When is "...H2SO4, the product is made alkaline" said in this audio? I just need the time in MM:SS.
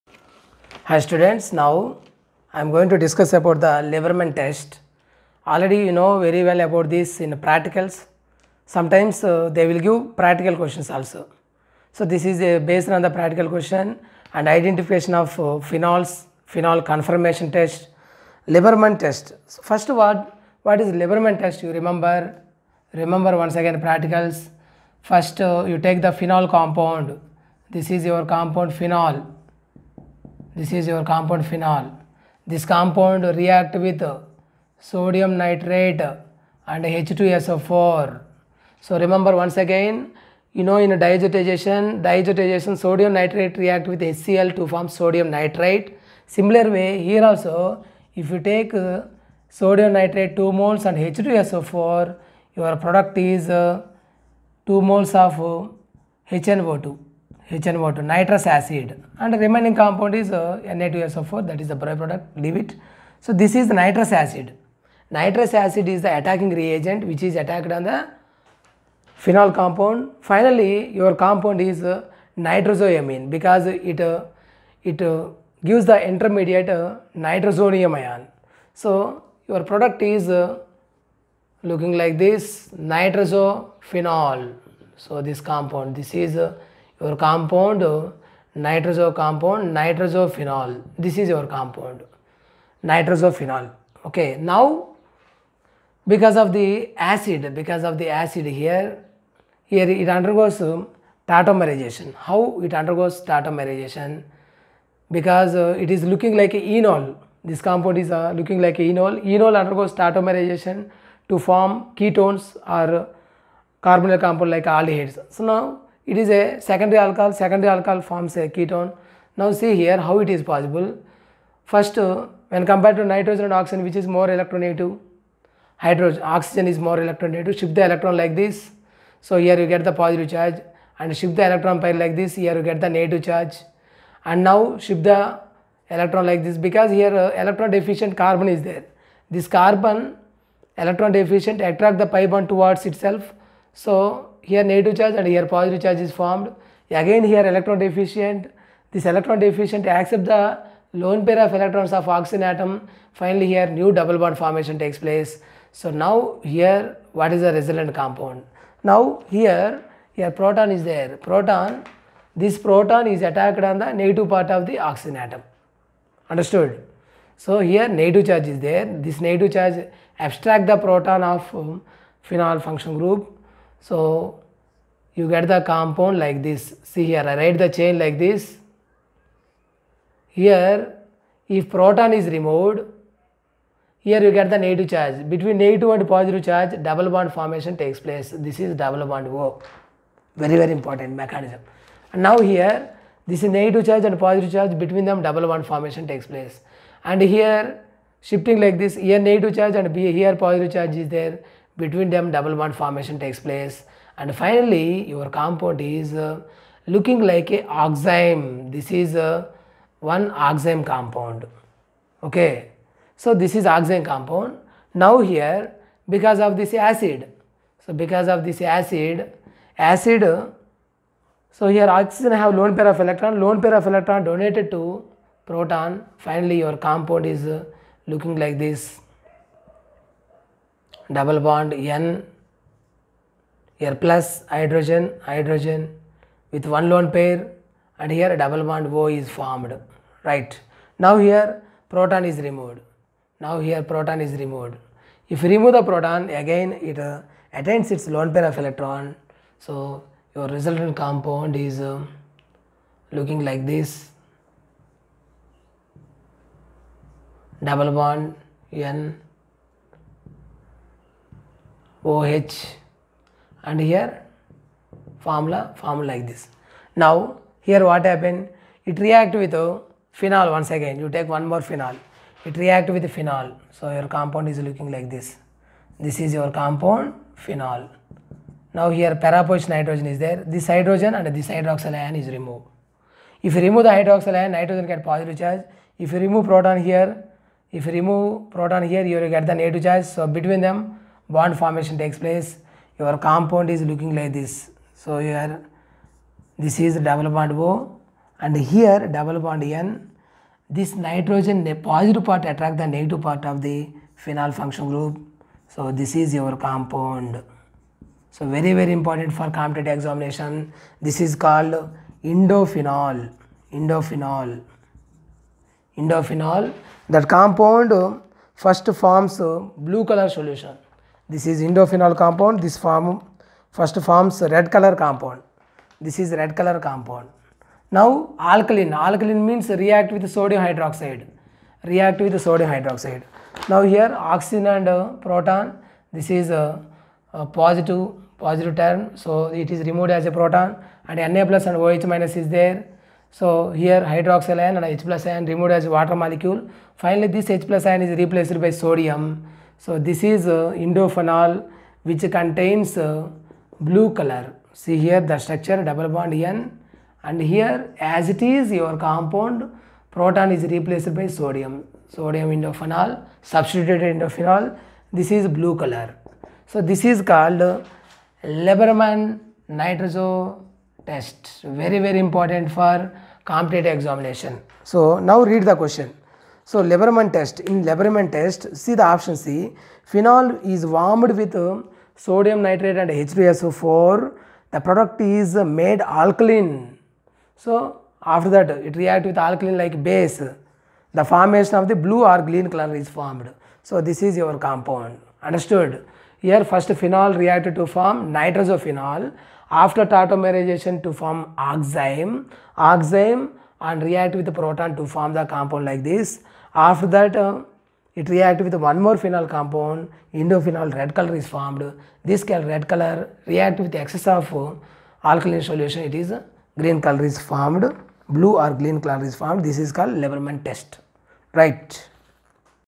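06:23.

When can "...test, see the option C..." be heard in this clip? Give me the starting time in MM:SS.
06:18.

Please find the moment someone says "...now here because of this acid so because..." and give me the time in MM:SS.
03:35.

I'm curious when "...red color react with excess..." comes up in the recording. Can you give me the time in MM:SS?
06:52.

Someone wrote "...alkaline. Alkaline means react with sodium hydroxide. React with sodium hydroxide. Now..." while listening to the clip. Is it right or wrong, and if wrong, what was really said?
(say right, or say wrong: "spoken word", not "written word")
right.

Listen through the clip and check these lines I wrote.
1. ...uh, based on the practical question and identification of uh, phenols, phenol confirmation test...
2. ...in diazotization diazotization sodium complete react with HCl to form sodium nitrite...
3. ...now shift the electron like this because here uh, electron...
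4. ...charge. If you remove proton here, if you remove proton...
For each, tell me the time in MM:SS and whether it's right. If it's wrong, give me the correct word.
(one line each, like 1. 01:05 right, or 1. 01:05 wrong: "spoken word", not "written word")
1. 00:12 right
2. 00:40 wrong: "nitrate", not "complete"
3. 02:14 right
4. 04:45 right.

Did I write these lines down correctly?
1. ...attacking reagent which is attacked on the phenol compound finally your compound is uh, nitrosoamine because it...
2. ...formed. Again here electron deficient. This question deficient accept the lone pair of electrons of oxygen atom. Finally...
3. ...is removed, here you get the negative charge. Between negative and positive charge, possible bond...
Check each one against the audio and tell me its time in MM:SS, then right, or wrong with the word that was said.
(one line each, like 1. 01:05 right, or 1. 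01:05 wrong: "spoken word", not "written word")
1. 01:06 right
2. 02:26 wrong: "electron", not "question"
3. 03:02 wrong: "double", not "possible".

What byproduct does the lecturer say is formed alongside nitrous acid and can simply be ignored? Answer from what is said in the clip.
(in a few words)
Na2SO4.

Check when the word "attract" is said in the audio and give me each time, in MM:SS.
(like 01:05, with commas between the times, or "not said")
02:21, 05:02.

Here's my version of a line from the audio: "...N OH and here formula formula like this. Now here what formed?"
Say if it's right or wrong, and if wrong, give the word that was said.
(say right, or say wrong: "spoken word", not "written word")
wrong: "happened", not "formed".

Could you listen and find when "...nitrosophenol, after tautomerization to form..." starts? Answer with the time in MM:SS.
06:38.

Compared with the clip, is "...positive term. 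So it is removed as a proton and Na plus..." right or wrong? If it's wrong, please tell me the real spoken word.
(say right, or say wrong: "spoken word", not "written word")
right.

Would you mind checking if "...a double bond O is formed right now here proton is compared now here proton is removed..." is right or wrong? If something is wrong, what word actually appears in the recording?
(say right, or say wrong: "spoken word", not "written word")
wrong: "removed", not "compared".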